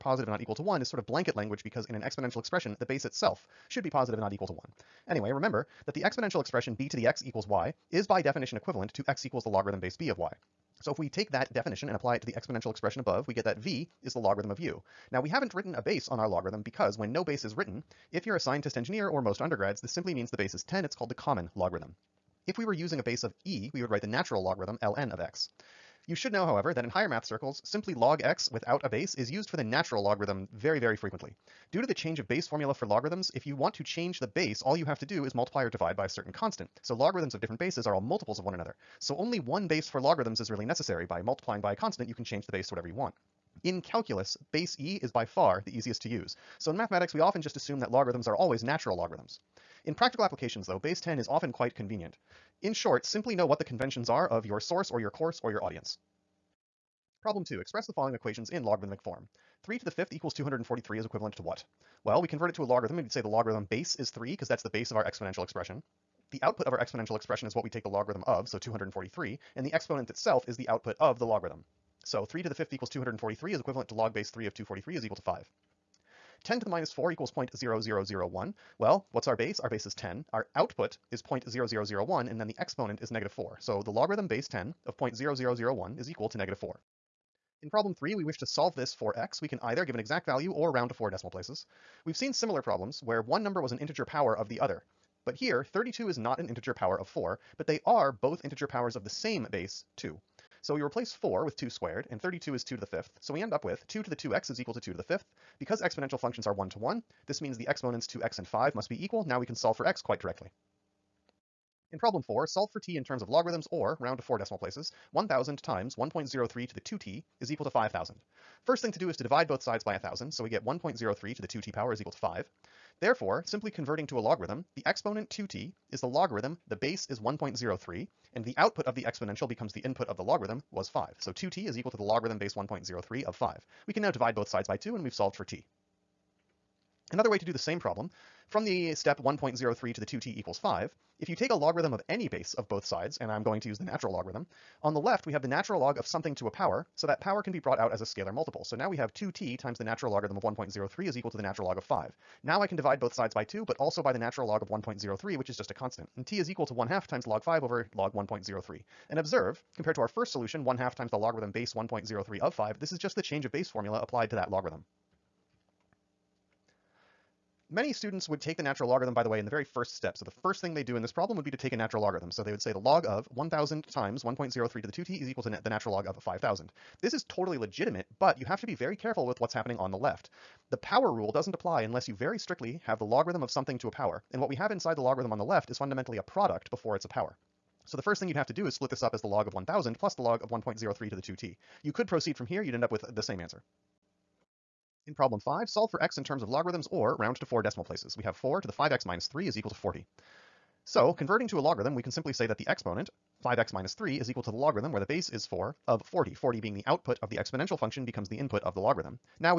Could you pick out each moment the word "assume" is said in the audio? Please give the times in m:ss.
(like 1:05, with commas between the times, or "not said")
0:47.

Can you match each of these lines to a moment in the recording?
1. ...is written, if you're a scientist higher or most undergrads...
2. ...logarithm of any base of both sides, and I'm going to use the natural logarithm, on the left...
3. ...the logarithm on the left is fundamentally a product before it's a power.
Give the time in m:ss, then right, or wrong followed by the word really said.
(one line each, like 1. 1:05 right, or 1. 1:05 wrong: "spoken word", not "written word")
1. 0:17 wrong: "engineer", not "higher"
2. 2:21 right
3. 3:04 right.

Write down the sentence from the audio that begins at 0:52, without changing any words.
In short, simply know what the conventions are of your source or your course or your audience.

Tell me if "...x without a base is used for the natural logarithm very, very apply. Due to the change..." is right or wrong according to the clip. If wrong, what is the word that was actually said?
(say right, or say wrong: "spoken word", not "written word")
wrong: "frequently", not "apply".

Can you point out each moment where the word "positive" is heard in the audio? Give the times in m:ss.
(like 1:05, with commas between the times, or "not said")
0:03.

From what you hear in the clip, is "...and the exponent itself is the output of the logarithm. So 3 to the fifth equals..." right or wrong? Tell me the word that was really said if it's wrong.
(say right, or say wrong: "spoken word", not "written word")
right.